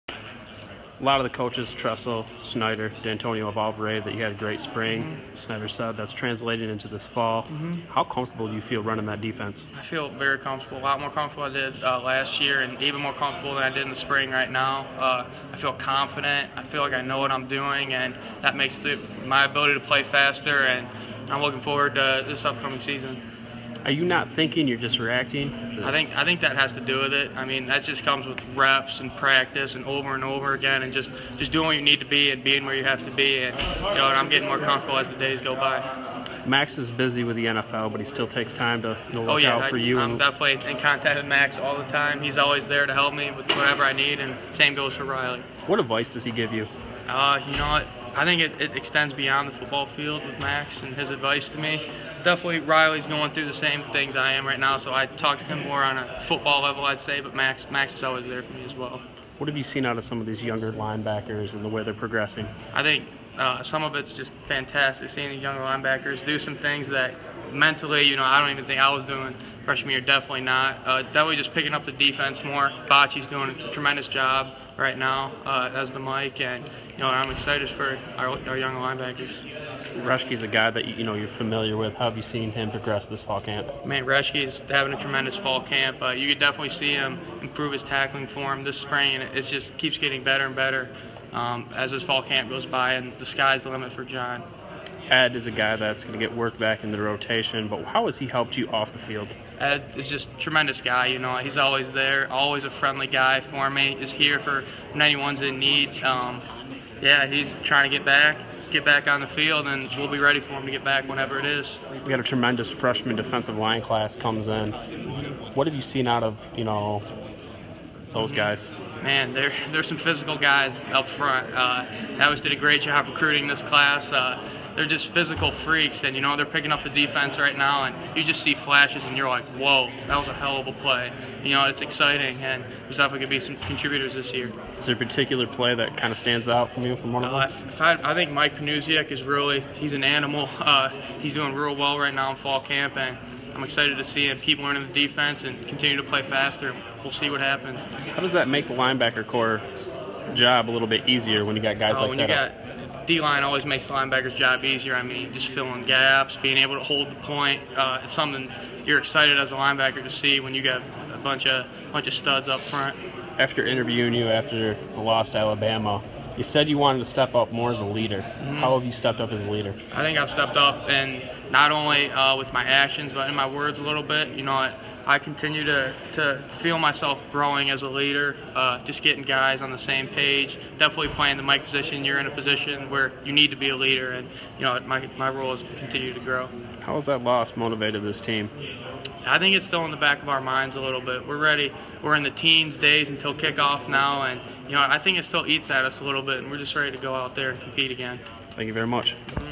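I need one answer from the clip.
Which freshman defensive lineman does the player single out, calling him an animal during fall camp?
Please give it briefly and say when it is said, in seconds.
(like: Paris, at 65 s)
Mike Panasiuk, at 138 s.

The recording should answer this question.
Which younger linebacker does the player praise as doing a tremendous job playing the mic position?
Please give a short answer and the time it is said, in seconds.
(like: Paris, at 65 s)
Bachie, at 72 s.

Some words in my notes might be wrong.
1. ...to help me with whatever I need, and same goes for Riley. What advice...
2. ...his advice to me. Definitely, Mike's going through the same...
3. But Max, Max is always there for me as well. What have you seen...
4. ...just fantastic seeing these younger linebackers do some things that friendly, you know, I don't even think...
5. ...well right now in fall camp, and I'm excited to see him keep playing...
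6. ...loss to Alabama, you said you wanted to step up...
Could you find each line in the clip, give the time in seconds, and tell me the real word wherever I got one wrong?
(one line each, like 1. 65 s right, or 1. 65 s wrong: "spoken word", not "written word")
1. 42 s right
2. 50 s wrong: "Riley", not "Mike"
3. 57 s right
4. 64 s wrong: "mentally", not "friendly"
5. 141 s wrong: "learning", not "playing"
6. 165 s right.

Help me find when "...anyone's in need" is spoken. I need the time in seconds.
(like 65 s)
105 s.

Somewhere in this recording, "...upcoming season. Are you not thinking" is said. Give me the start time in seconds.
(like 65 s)
22 s.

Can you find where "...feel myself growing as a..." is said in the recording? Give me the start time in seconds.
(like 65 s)
176 s.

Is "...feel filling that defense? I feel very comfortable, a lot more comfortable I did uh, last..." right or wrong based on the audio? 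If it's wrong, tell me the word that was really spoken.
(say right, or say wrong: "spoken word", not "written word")
wrong: "running", not "filling".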